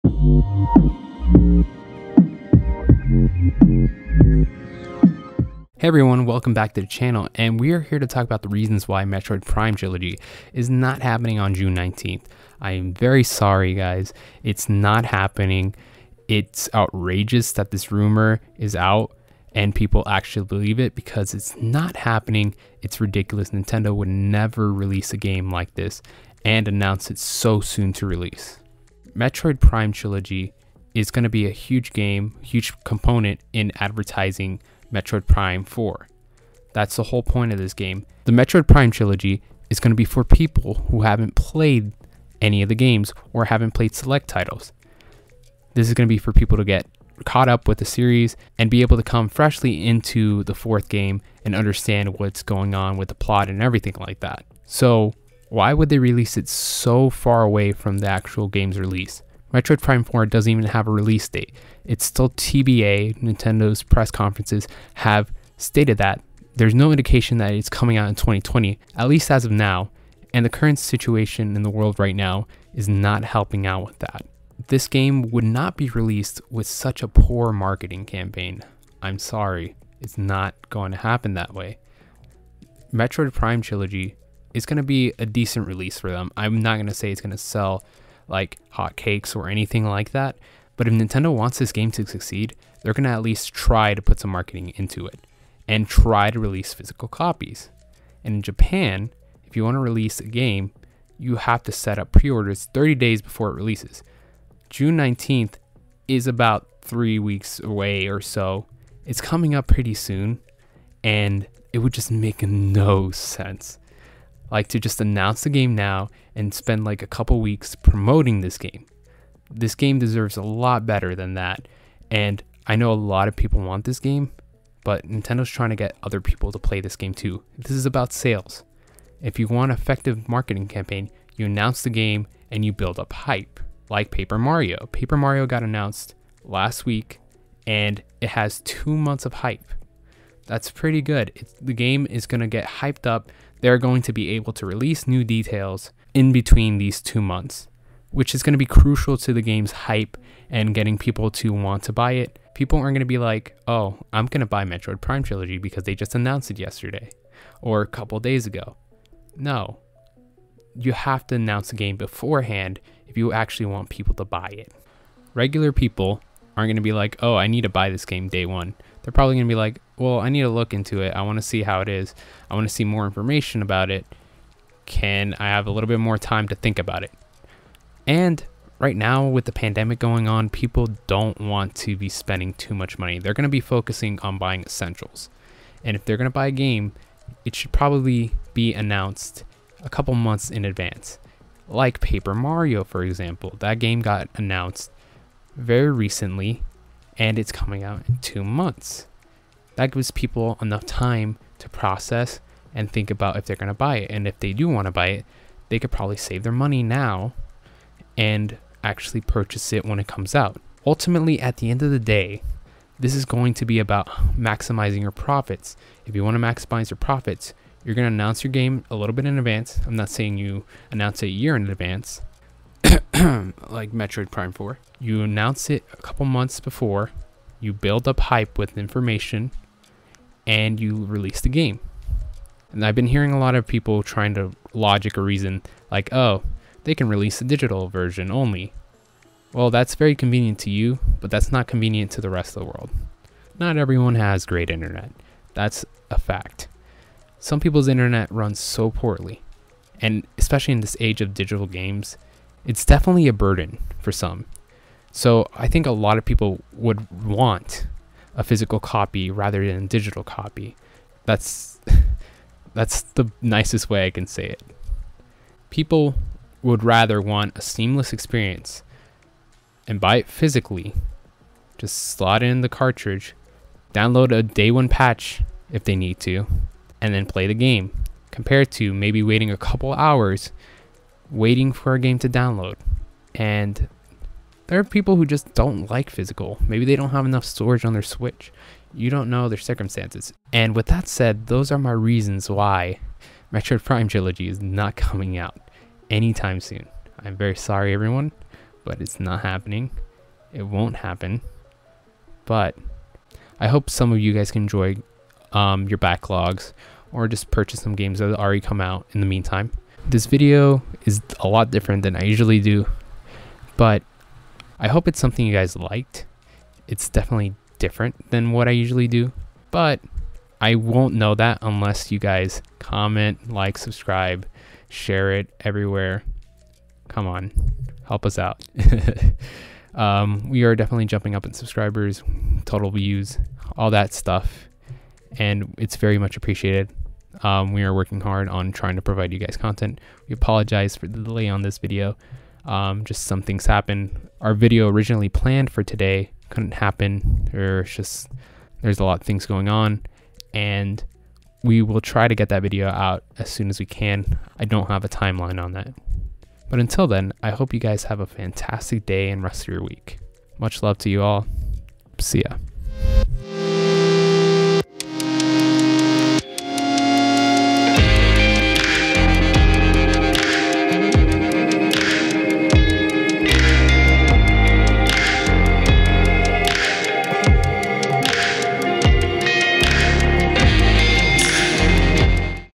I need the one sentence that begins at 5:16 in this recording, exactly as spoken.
It's definitely different than what I usually do, but I won't know that unless you guys comment, like, subscribe, share it everywhere.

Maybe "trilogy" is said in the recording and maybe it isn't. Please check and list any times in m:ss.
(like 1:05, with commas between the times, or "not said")
0:09, 0:29, 0:38, 1:23, 2:35, 4:54.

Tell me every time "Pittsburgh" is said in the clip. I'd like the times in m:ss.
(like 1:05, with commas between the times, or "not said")
not said.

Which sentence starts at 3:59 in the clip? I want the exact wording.
Well, that's very convenient to you, but that's not convenient to the rest of the world.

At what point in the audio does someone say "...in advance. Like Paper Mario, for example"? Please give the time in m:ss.
3:10.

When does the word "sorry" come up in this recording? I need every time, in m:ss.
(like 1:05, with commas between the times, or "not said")
0:13, 1:19, 4:57.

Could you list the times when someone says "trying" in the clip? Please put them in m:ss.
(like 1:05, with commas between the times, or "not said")
2:05, 3:54, 5:38.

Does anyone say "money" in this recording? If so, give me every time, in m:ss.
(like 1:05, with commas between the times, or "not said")
3:02, 3:26.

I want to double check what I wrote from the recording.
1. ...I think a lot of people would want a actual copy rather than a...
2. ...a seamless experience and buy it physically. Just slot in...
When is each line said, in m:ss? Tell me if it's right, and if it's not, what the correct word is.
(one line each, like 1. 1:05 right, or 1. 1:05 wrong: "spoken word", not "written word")
1. 4:15 wrong: "physical", not "actual"
2. 4:27 right.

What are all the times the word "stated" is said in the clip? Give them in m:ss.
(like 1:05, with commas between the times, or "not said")
1:05.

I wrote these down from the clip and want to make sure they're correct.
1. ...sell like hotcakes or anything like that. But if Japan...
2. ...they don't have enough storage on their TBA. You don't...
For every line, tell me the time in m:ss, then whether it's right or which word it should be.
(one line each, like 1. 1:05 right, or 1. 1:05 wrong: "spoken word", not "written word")
1. 1:27 wrong: "Nintendo", not "Japan"
2. 4:46 wrong: "Switch", not "TBA".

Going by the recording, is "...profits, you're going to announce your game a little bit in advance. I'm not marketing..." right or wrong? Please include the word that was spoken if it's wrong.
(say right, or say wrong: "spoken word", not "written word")
wrong: "saying", not "marketing".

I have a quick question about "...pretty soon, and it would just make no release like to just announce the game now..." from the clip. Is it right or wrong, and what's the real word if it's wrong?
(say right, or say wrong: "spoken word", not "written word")
wrong: "sense", not "release".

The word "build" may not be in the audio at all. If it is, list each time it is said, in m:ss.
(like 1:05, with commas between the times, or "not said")
2:12, 3:47.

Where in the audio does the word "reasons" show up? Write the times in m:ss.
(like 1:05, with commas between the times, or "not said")
0:08, 3:55, 4:51.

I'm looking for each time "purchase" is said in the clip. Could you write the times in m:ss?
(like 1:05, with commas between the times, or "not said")
3:29, 5:07.